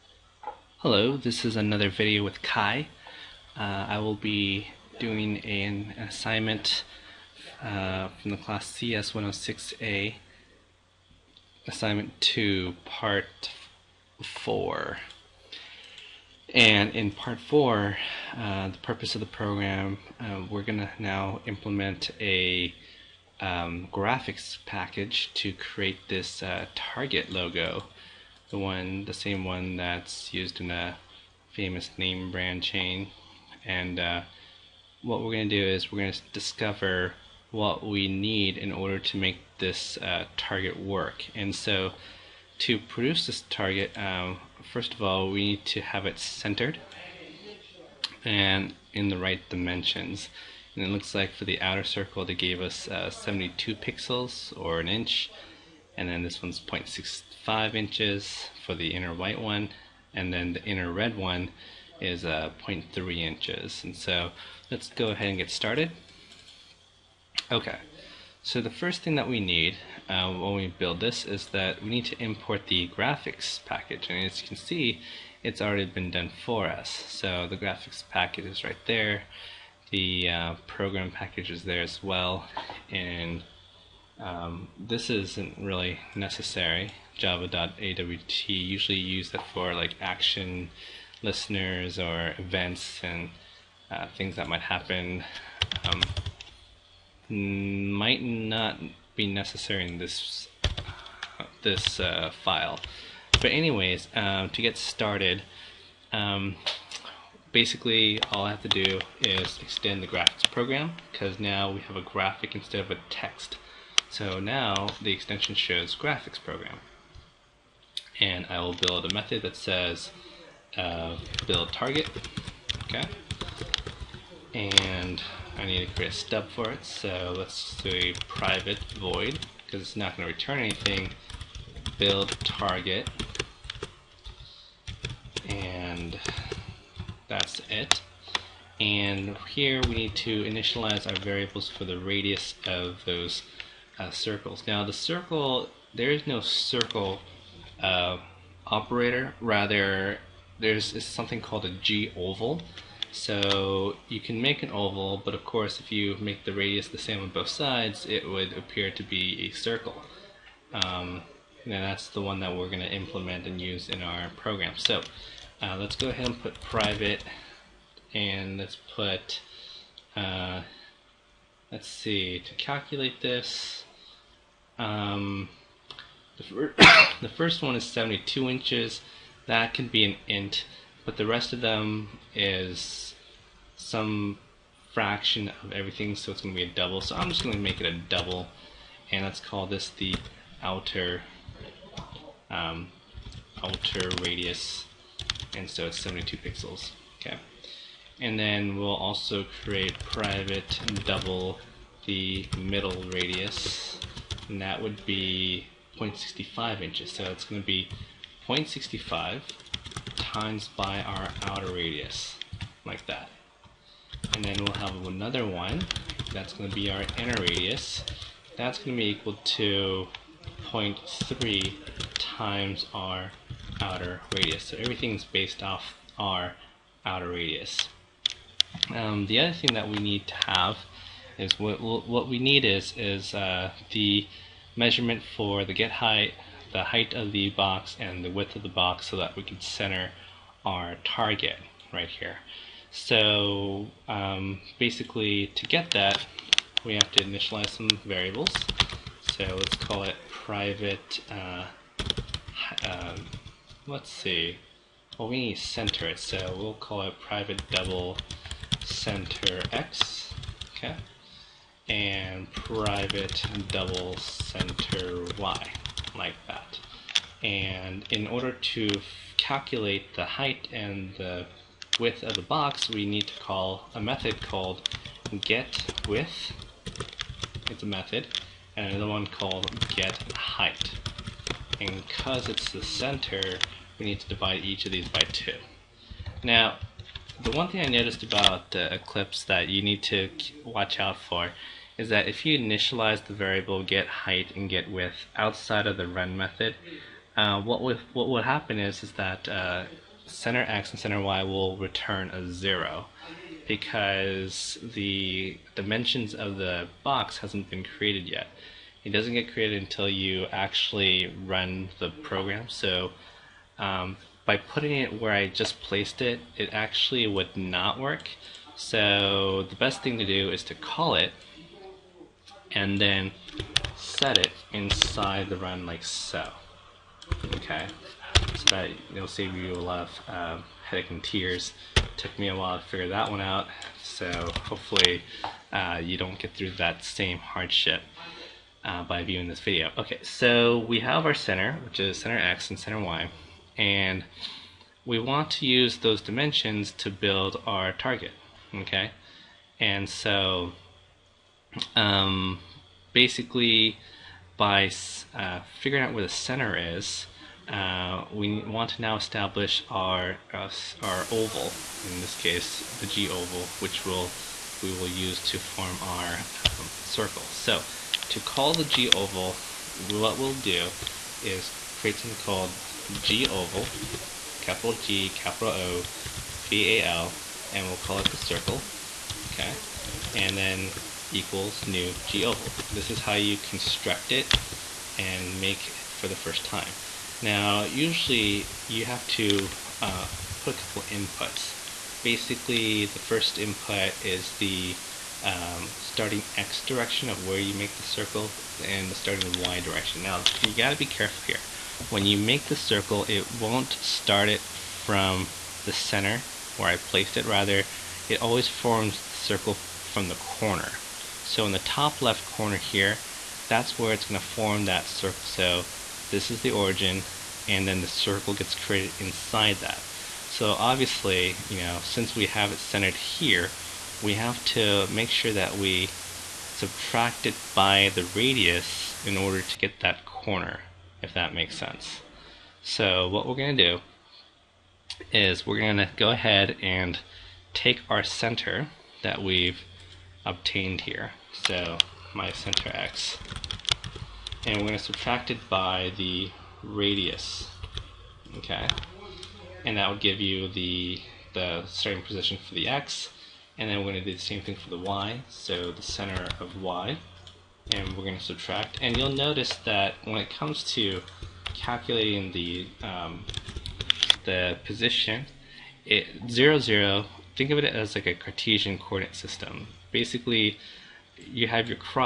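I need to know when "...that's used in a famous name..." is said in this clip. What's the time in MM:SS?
00:29.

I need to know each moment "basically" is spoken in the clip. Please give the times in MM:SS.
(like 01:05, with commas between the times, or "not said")
01:47, 04:04, 05:53, 06:32, 07:50.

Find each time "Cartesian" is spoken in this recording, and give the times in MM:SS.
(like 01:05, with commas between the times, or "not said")
07:48.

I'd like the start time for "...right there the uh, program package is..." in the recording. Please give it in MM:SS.
01:18.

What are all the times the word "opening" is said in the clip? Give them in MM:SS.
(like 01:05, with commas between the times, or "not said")
not said.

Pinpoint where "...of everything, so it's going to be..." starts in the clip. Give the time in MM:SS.
03:05.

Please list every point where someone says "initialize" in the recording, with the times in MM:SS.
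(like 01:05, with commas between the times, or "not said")
02:20, 04:07, 04:52.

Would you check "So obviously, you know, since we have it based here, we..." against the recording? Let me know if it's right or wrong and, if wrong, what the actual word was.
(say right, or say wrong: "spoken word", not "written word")
wrong: "centered", not "based".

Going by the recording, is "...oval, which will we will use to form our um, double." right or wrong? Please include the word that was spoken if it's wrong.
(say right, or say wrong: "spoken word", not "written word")
wrong: "circle", not "double".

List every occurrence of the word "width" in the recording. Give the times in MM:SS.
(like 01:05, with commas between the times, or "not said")
03:58, 04:31, 04:36, 04:54.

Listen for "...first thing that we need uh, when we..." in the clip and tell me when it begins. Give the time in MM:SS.
01:08.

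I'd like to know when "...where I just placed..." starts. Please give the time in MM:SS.
05:15.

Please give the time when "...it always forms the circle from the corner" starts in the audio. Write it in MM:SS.
06:48.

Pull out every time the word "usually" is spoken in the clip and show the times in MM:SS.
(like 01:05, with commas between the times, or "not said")
01:28, 06:27.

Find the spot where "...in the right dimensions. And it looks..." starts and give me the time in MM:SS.
00:48.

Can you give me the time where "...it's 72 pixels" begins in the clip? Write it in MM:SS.
03:15.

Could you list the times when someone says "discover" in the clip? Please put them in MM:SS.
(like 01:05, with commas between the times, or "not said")
00:36.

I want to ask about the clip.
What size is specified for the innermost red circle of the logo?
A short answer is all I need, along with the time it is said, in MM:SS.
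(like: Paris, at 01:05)
0.3 inches, at 01:02.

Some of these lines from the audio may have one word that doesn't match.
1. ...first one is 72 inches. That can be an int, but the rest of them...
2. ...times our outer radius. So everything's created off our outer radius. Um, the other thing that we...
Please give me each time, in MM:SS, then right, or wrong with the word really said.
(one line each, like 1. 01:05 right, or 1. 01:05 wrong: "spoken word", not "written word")
1. 02:57 right
2. 03:42 wrong: "based", not "created".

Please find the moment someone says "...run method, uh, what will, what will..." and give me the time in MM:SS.
04:56.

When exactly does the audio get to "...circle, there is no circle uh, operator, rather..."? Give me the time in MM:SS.
02:24.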